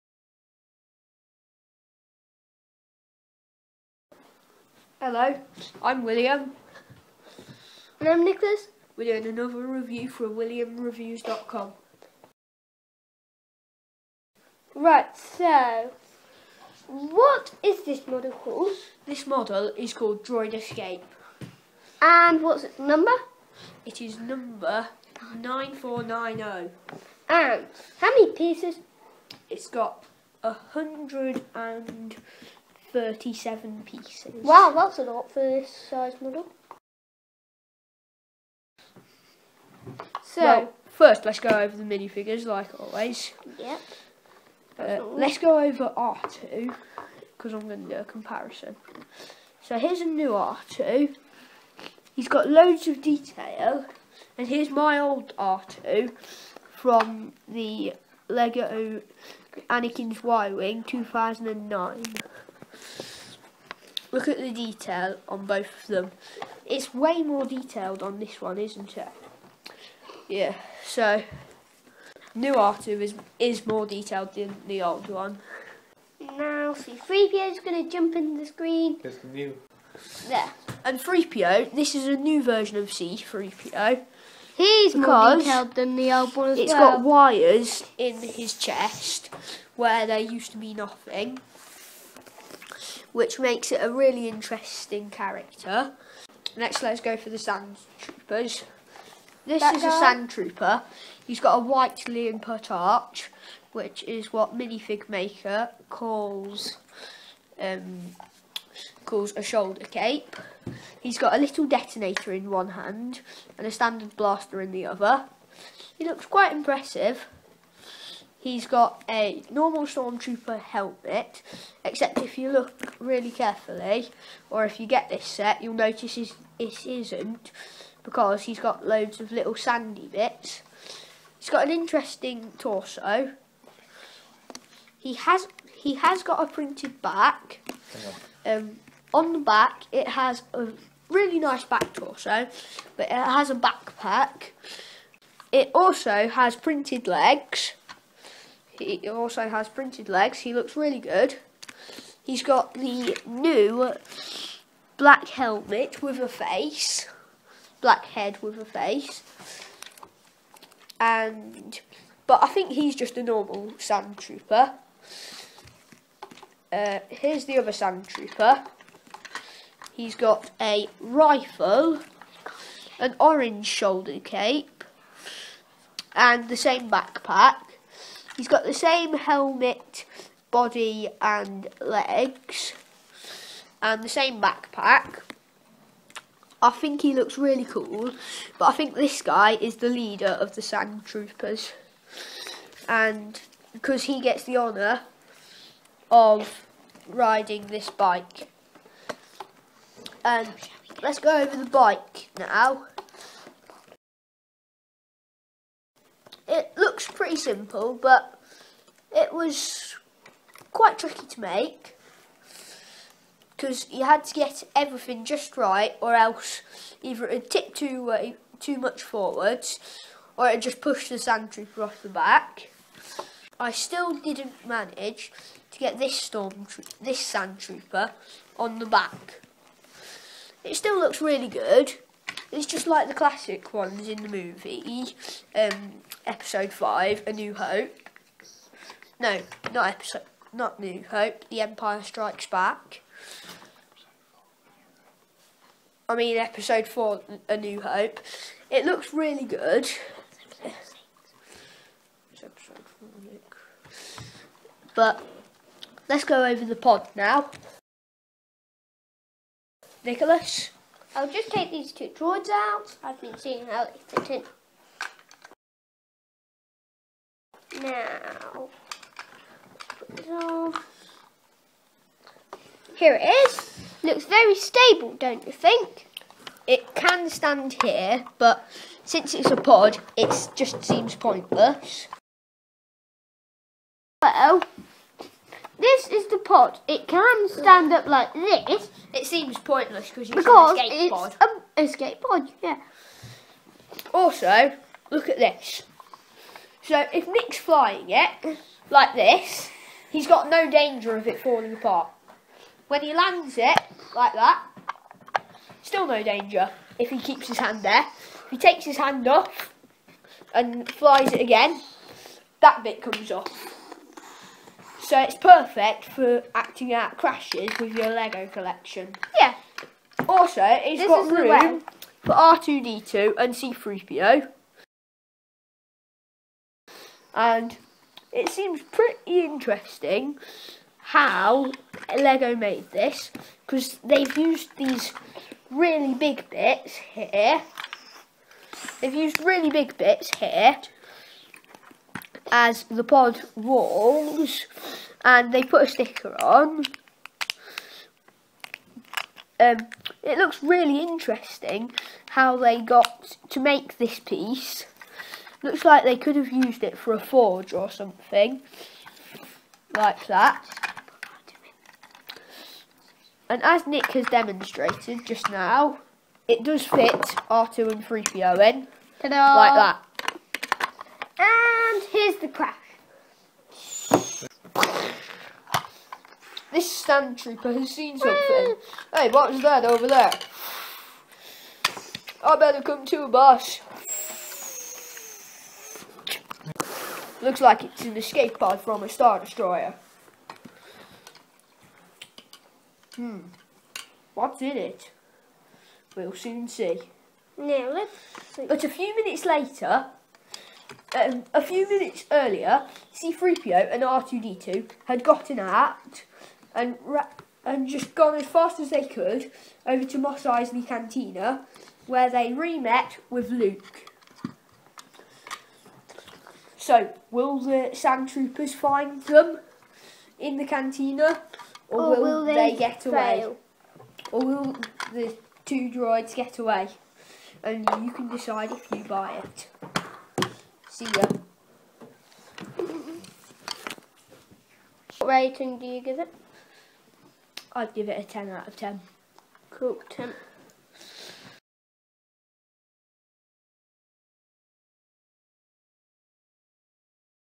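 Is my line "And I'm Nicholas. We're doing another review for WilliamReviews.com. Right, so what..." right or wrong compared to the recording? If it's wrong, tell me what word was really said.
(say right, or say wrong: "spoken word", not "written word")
right.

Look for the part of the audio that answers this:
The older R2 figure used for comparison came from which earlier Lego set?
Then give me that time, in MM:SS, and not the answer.
00:58.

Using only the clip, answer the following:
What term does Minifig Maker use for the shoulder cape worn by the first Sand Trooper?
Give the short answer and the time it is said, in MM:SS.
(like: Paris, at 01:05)
Leonput arch, at 01:42.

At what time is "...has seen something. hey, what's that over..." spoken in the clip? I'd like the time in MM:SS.
06:17.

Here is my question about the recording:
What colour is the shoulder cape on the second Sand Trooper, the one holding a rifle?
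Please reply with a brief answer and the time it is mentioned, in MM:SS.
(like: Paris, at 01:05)
Orange, at 02:53.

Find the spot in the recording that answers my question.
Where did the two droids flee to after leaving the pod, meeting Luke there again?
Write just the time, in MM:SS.
06:50.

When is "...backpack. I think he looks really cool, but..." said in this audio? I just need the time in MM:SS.
03:04.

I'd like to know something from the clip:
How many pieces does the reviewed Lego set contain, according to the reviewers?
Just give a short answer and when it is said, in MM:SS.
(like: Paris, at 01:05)
137, at 00:30.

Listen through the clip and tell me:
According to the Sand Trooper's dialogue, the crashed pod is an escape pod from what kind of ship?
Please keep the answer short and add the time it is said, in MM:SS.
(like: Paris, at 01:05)
Star Destroyer, at 06:29.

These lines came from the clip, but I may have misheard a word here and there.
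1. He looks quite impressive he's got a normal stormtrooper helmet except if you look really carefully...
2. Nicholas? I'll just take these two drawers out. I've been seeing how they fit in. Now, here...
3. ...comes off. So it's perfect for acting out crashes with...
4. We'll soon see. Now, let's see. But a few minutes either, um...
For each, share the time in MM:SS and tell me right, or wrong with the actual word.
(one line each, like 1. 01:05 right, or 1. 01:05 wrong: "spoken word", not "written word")
1. 01:55 right
2. 04:20 right
3. 05:13 right
4. 06:36 wrong: "later", not "either".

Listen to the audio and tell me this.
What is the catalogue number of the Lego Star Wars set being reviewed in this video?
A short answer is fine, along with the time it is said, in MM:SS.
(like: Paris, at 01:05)
9490, at 00:24.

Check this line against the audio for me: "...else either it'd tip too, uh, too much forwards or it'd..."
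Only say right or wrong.
right.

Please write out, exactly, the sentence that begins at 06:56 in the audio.
So, will the sand troopers find them in the cantina, or, or will, will, they, they get fail?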